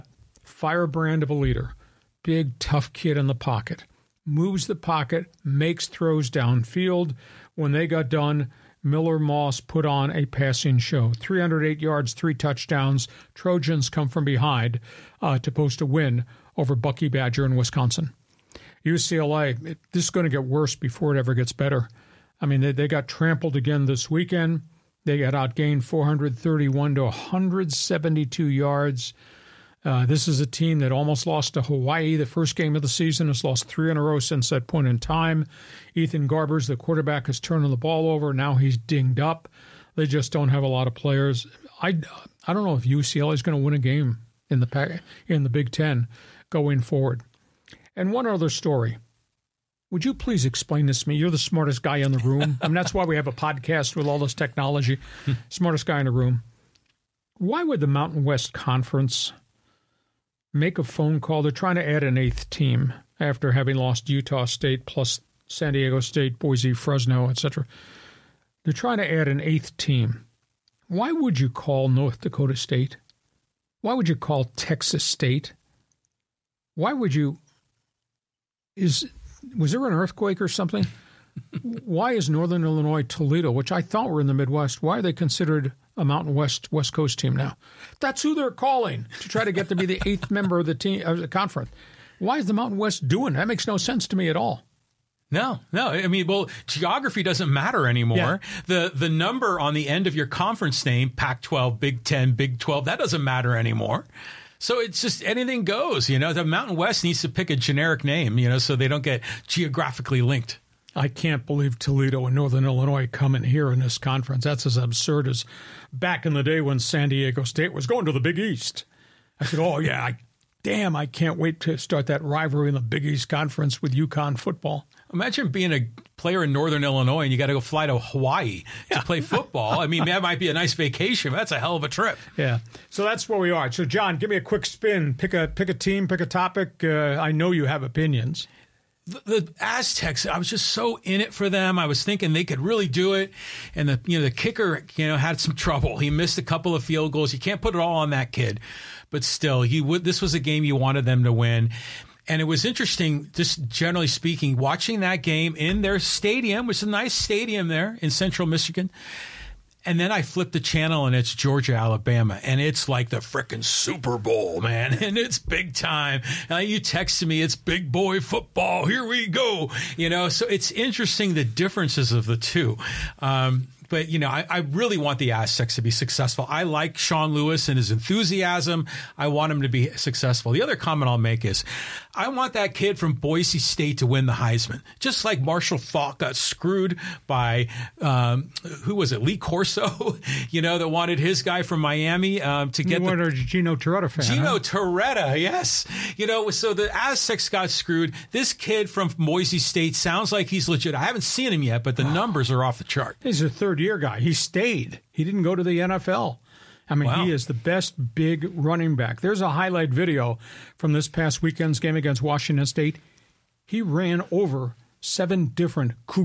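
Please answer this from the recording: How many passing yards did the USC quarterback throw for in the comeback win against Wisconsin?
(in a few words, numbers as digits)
308.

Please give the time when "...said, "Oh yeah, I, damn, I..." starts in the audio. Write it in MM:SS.
01:59.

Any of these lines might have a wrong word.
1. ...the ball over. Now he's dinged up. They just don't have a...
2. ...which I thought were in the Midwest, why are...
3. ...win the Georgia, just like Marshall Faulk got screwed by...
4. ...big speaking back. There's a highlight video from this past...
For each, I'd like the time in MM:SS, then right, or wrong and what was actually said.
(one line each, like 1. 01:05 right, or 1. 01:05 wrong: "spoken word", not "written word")
1. 00:37 right
2. 01:23 right
3. 03:04 wrong: "Heisman", not "Georgia"
4. 03:28 wrong: "running", not "speaking".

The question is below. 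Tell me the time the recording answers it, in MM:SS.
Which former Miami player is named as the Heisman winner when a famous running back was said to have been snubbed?
03:13.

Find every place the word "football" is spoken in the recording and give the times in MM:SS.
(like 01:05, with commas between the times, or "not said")
02:04, 02:09, 02:48.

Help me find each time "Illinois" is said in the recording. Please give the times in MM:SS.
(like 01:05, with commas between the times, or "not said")
01:22, 01:52, 02:06.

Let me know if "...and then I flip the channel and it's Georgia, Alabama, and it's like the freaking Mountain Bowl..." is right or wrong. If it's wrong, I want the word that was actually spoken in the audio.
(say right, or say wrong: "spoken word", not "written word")
wrong: "Super", not "Mountain".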